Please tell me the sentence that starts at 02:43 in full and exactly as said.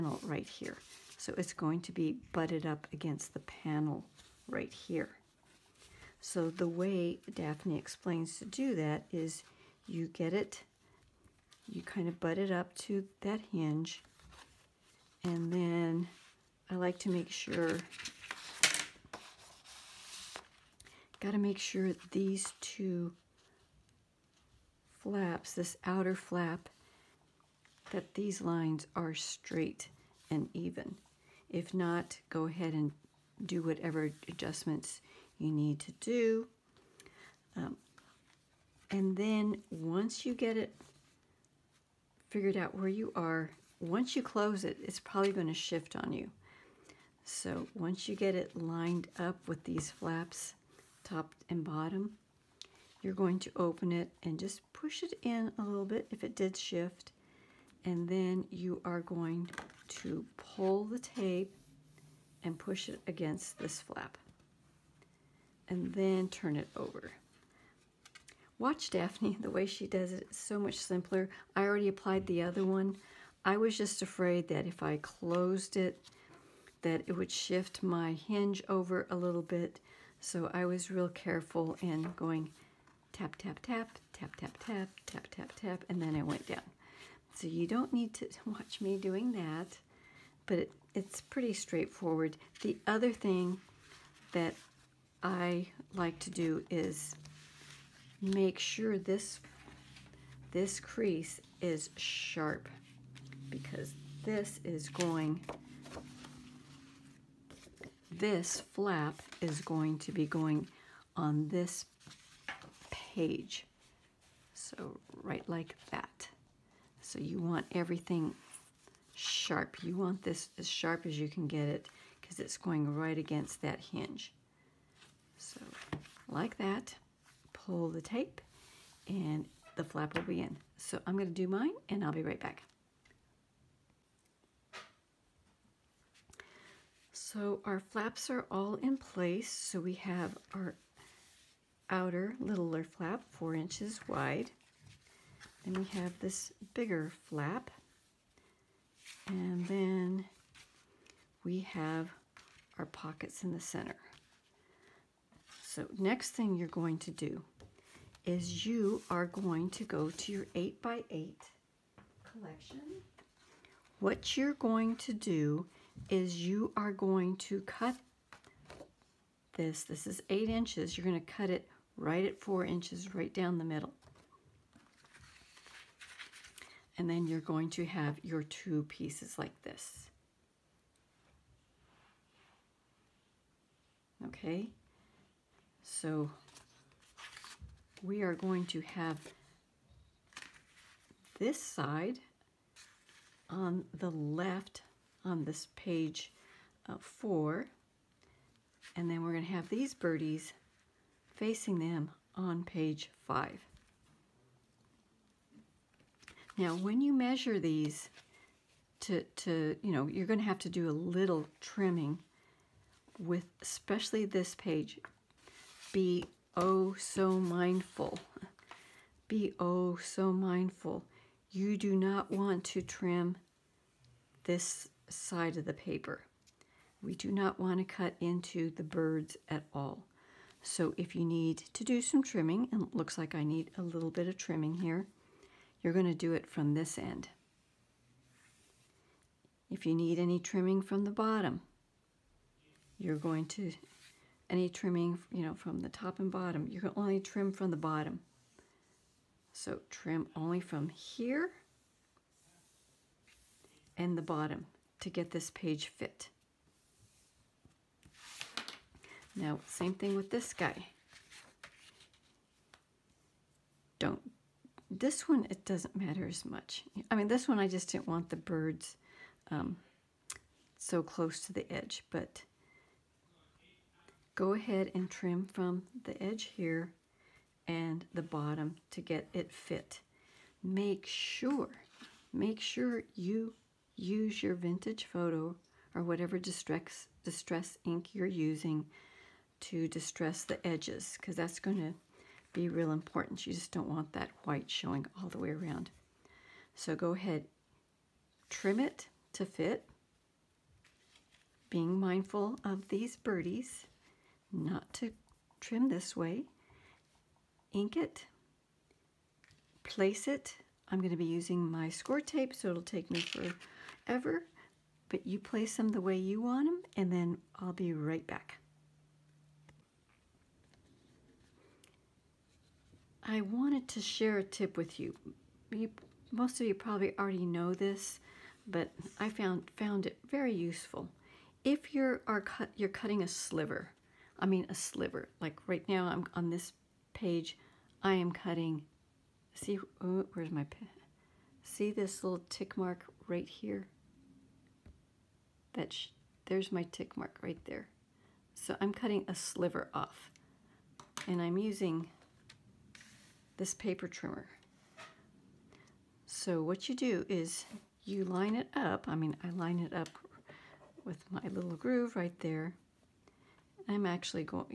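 What you're going to do is you are going to cut this.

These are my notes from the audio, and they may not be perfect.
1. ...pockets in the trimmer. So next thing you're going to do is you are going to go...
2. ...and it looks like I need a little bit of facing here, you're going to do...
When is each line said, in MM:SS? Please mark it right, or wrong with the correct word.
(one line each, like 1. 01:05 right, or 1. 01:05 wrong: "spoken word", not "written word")
1. 02:32 wrong: "center", not "trimmer"
2. 03:52 wrong: "trimming", not "facing".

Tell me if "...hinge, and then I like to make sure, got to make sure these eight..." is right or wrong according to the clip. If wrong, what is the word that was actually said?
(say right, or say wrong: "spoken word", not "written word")
wrong: "two", not "eight".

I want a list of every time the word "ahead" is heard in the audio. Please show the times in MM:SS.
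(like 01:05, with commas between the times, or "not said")
00:32, 04:34, 04:57.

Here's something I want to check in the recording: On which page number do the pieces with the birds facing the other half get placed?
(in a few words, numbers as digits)
5.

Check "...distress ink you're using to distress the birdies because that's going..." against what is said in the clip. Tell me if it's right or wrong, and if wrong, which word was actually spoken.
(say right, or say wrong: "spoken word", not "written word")
wrong: "edges", not "birdies".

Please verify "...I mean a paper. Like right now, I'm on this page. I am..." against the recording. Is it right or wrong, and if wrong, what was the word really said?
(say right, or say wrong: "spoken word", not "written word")
wrong: "sliver", not "paper".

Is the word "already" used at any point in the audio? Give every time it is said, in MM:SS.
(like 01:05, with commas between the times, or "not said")
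01:11, 05:27.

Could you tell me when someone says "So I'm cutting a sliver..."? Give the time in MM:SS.
05:48.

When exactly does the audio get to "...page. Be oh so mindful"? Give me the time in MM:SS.
03:34.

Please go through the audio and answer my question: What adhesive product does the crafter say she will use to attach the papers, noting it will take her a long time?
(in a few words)
Score tape.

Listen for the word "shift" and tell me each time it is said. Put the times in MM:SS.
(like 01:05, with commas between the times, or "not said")
00:45, 00:56, 01:17.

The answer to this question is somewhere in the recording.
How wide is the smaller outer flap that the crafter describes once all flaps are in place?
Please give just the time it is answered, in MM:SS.
02:23.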